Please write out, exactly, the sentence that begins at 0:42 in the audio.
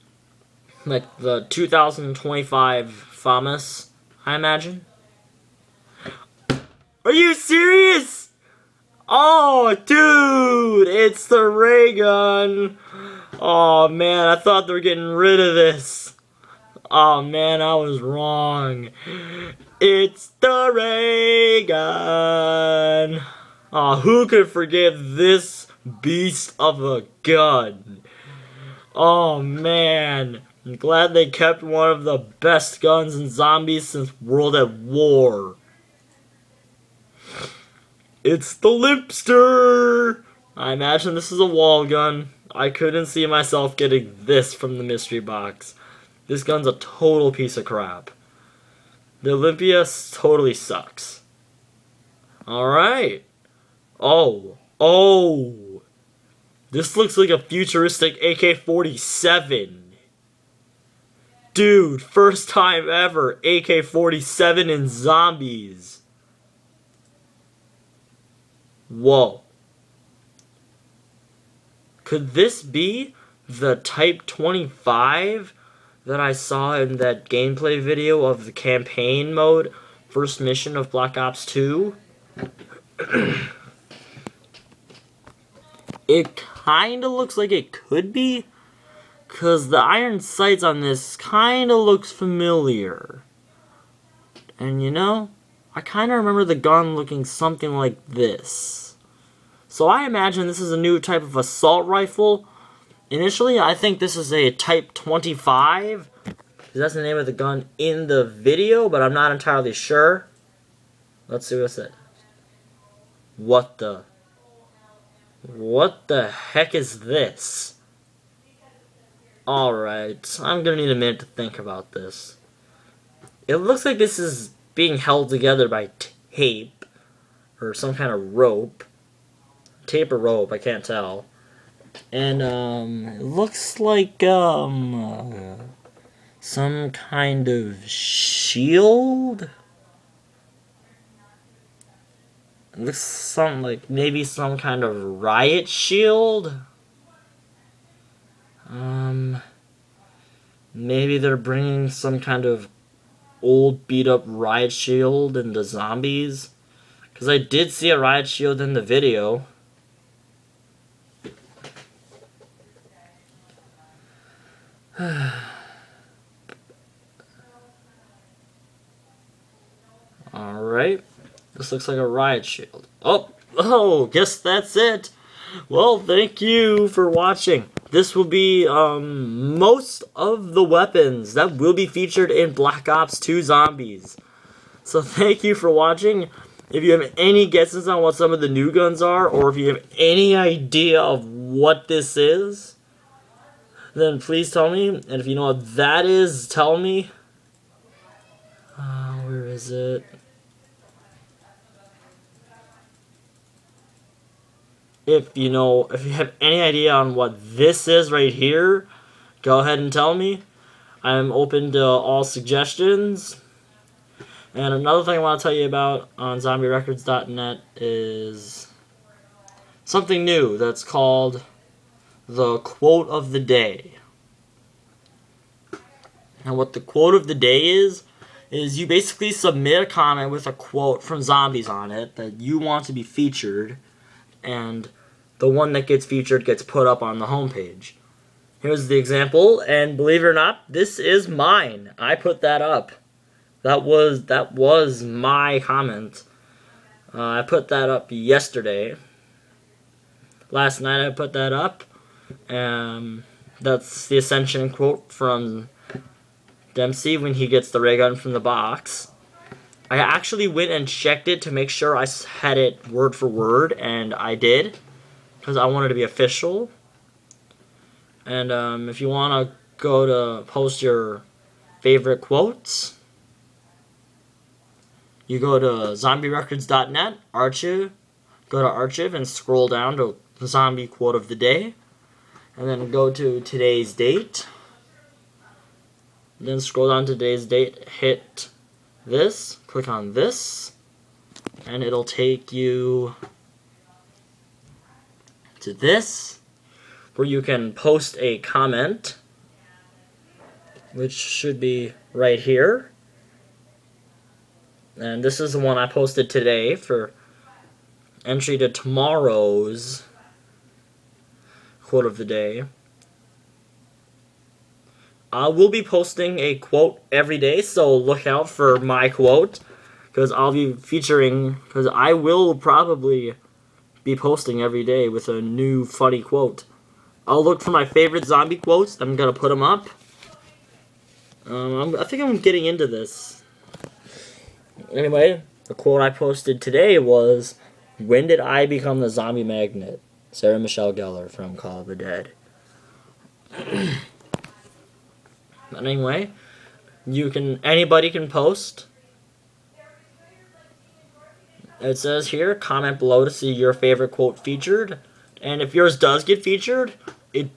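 I couldn't see myself getting this from the mystery box.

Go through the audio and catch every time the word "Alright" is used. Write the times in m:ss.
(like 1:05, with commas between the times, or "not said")
1:59, 2:50.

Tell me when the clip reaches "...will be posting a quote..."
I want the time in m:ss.
5:15.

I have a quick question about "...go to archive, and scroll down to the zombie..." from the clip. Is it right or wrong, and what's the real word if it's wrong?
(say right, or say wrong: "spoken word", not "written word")
right.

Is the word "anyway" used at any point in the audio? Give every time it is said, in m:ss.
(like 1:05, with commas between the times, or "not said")
5:34, 5:45.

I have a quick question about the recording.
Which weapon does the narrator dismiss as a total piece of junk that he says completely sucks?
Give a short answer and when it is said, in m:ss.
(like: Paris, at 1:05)
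Olympia, at 0:49.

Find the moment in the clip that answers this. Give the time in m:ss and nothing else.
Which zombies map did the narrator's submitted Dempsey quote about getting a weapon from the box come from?
4:14.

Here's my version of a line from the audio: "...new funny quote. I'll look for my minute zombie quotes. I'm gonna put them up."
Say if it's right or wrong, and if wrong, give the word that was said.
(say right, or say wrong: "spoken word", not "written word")
wrong: "favorite", not "minute".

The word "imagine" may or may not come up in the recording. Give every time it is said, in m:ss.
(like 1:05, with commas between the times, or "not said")
0:04, 0:40, 1:40.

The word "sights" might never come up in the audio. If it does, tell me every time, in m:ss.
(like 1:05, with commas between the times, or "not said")
1:30.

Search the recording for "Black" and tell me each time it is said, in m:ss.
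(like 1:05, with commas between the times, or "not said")
1:20, 3:02.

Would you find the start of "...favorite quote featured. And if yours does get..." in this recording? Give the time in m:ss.
5:53.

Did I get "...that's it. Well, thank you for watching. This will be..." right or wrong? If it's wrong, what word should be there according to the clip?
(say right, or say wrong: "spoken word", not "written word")
right.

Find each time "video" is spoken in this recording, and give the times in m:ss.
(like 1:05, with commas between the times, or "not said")
1:17, 1:48, 2:38.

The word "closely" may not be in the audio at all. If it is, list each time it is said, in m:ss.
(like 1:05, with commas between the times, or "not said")
not said.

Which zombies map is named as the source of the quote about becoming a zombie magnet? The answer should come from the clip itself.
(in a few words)
Call of the Dead.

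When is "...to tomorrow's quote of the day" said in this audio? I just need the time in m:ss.
5:08.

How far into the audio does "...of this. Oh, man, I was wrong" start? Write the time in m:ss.
0:15.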